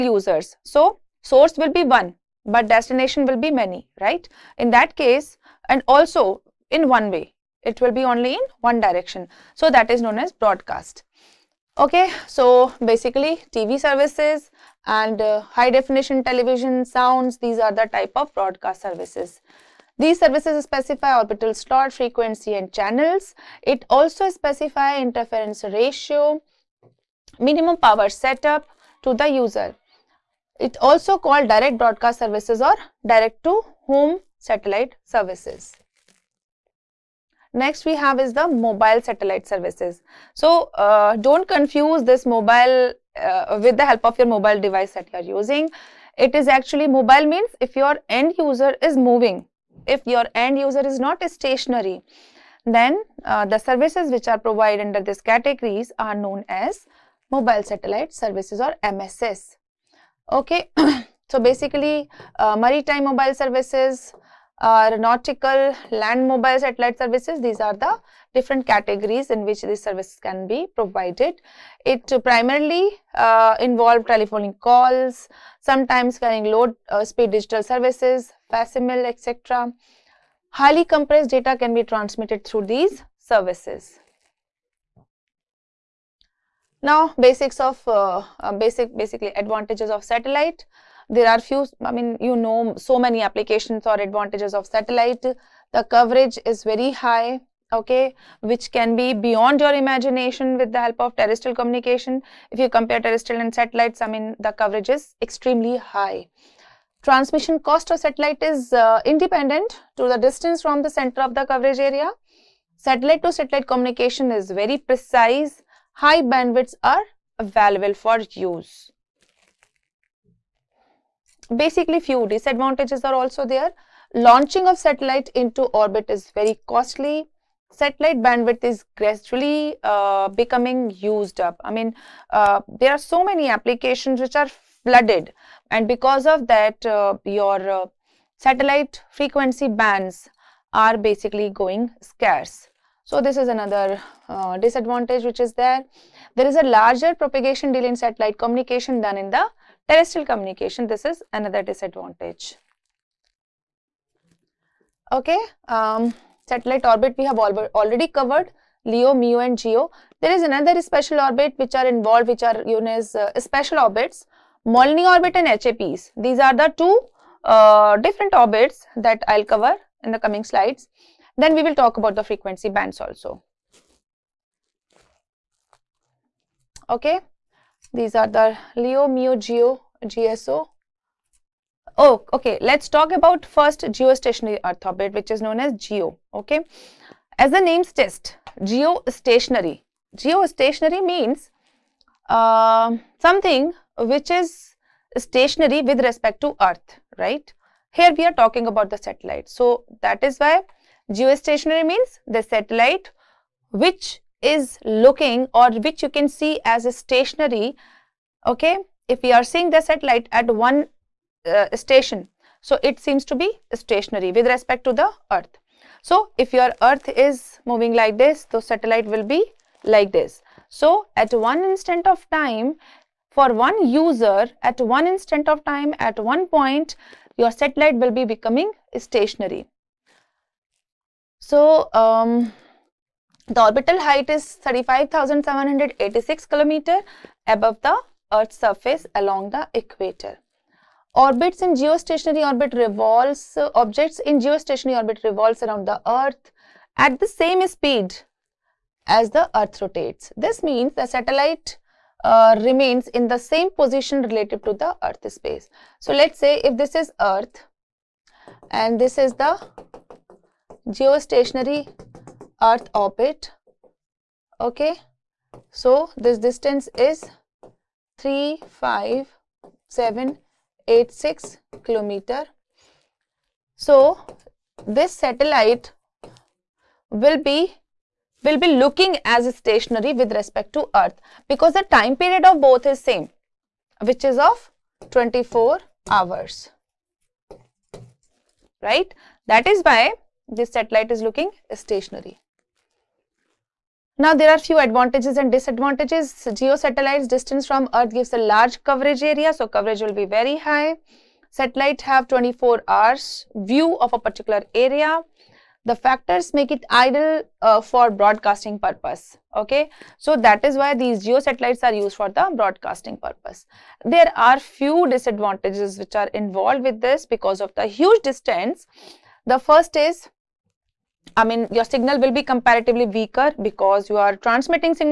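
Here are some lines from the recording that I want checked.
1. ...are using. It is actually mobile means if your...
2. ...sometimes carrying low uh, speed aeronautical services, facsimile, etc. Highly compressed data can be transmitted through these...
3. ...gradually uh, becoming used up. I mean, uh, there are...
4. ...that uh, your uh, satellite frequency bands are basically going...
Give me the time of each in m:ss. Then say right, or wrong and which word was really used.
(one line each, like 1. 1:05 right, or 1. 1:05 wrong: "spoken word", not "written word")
1. 0:45 right
2. 1:15 wrong: "digital", not "aeronautical"
3. 2:08 right
4. 2:16 right.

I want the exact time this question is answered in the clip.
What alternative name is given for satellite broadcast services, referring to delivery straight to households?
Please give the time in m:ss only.
0:33.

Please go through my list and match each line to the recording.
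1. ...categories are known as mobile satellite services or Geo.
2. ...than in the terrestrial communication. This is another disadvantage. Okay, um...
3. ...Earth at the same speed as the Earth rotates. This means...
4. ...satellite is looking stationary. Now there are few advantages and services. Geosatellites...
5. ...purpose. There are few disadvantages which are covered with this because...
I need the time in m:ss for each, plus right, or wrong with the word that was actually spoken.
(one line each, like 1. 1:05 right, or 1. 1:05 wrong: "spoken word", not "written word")
1. 0:55 wrong: "MSS", not "Geo"
2. 2:28 right
3. 4:06 right
4. 4:50 wrong: "disadvantages", not "services"
5. 5:13 wrong: "involved", not "covered".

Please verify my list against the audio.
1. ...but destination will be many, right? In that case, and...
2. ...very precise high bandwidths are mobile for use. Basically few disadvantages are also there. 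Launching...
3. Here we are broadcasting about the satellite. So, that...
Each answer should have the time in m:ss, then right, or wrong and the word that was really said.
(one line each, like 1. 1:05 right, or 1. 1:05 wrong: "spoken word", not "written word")
1. 0:02 right
2. 1:54 wrong: "available", not "mobile"
3. 3:17 wrong: "talking", not "broadcasting".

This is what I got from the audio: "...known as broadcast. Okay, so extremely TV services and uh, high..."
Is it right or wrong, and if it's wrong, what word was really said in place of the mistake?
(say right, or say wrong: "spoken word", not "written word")
wrong: "basically", not "extremely".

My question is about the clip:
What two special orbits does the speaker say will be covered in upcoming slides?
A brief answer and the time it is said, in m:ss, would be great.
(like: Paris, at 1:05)
Molniya orbit and HAPs, at 2:44.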